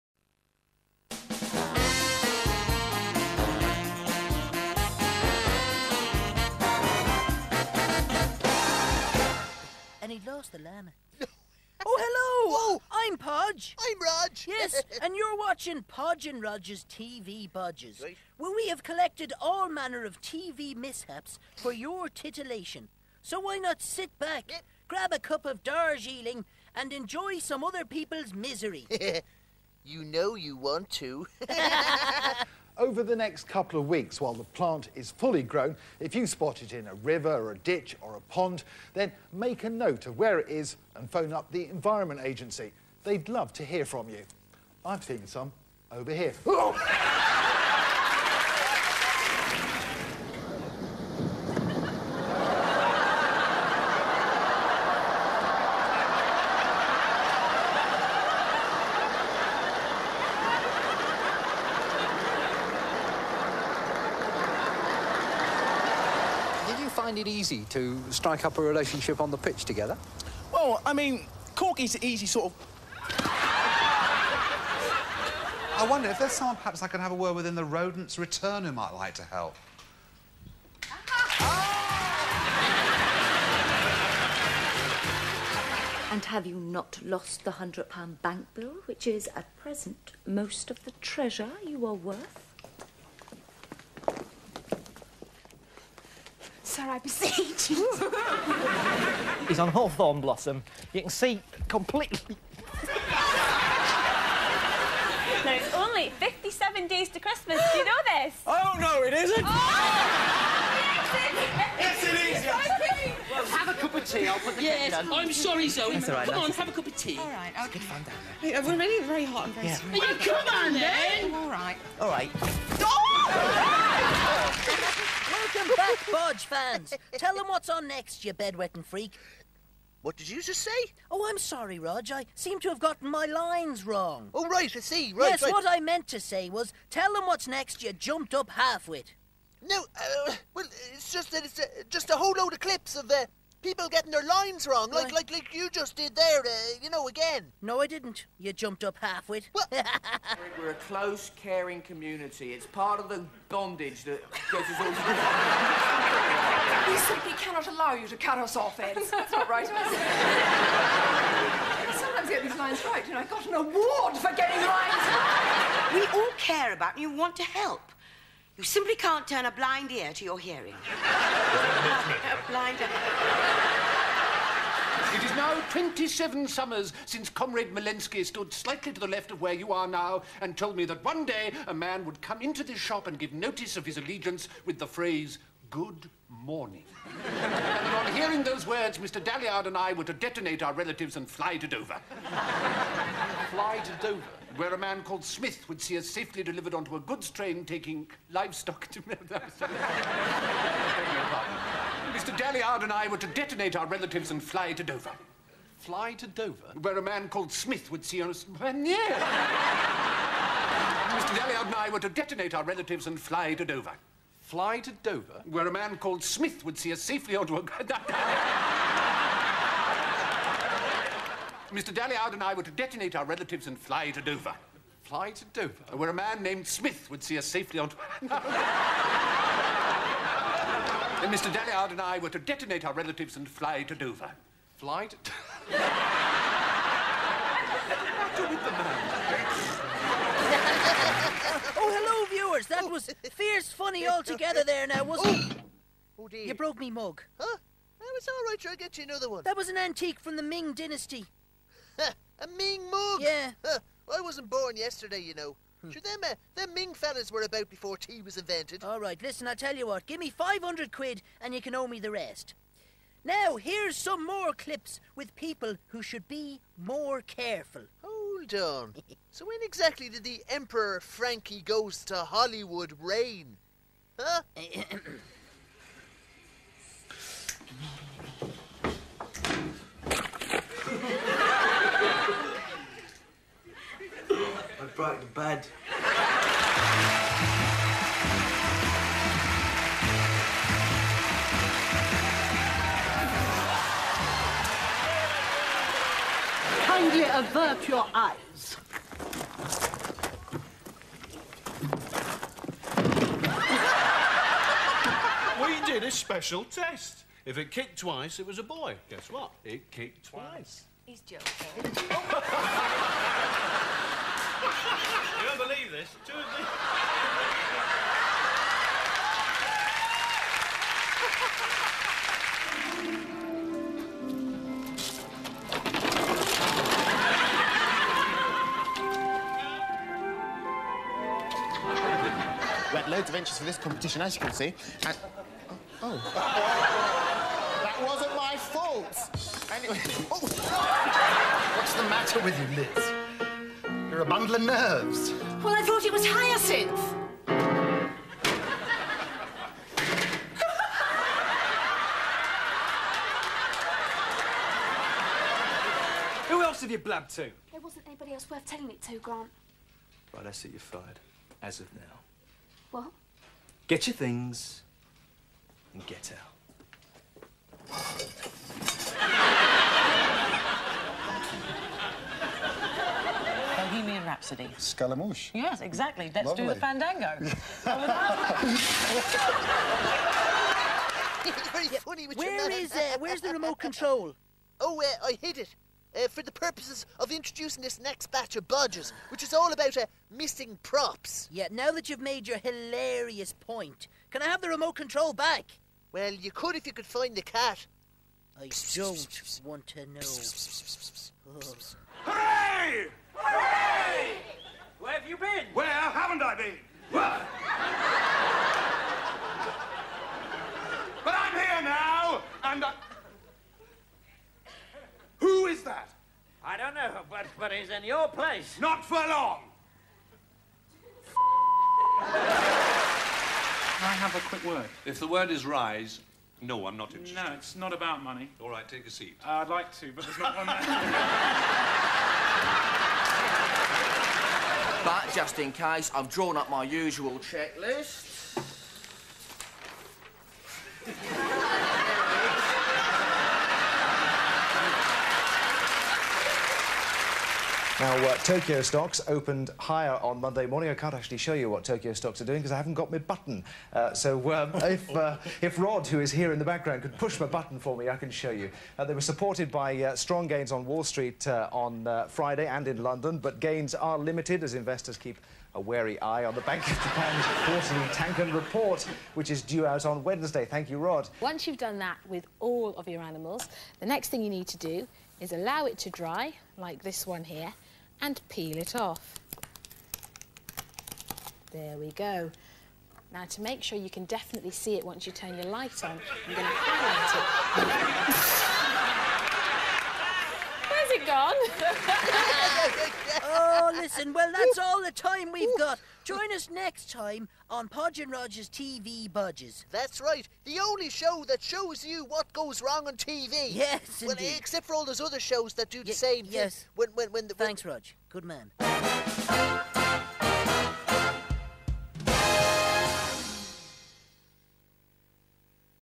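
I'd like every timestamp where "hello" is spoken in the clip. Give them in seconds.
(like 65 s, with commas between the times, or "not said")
11 s, 241 s.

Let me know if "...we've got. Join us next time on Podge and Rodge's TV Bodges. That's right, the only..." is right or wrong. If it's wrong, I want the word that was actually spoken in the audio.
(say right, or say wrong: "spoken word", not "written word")
right.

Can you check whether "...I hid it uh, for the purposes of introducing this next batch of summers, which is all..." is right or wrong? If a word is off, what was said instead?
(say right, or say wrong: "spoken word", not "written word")
wrong: "bodgers", not "summers".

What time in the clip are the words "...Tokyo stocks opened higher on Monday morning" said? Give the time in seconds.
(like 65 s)
448 s.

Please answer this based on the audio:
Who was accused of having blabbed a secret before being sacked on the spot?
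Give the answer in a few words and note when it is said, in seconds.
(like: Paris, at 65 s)
Grant, at 359 s.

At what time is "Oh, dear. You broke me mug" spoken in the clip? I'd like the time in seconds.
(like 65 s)
246 s.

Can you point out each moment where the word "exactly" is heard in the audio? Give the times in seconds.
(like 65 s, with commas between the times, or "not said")
269 s, 375 s.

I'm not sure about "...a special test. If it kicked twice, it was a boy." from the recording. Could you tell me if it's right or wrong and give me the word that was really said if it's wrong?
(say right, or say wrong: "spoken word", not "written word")
right.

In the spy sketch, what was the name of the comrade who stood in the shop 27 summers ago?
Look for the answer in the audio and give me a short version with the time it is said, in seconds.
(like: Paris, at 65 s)
Malensky, at 177 s.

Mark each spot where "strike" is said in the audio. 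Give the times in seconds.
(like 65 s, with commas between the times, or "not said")
68 s.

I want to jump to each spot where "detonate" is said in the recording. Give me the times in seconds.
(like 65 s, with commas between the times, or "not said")
190 s, 203 s, 212 s, 222 s, 232 s.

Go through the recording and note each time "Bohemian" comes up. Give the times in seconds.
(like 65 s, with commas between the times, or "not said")
373 s.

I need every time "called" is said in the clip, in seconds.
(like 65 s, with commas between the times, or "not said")
195 s, 207 s, 215 s.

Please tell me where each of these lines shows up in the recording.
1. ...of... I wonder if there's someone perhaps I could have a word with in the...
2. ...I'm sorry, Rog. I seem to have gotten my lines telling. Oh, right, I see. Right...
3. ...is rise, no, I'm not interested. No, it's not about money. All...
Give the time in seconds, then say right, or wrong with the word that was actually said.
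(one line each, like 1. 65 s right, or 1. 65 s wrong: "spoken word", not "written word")
1. 72 s right
2. 131 s wrong: "wrong", not "telling"
3. 425 s right.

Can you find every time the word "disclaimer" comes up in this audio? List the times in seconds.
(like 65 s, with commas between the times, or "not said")
not said.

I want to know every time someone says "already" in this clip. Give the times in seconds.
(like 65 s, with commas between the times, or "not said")
118 s.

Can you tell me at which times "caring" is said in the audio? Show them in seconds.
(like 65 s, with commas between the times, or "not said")
151 s.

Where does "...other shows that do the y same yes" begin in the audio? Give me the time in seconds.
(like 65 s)
505 s.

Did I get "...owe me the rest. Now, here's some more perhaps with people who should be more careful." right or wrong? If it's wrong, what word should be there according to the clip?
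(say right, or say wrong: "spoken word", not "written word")
wrong: "clips", not "perhaps".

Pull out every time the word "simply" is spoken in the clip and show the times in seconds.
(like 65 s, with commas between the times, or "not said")
157 s, 168 s.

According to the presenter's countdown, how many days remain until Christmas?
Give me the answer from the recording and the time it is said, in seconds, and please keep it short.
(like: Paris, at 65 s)
57, at 106 s.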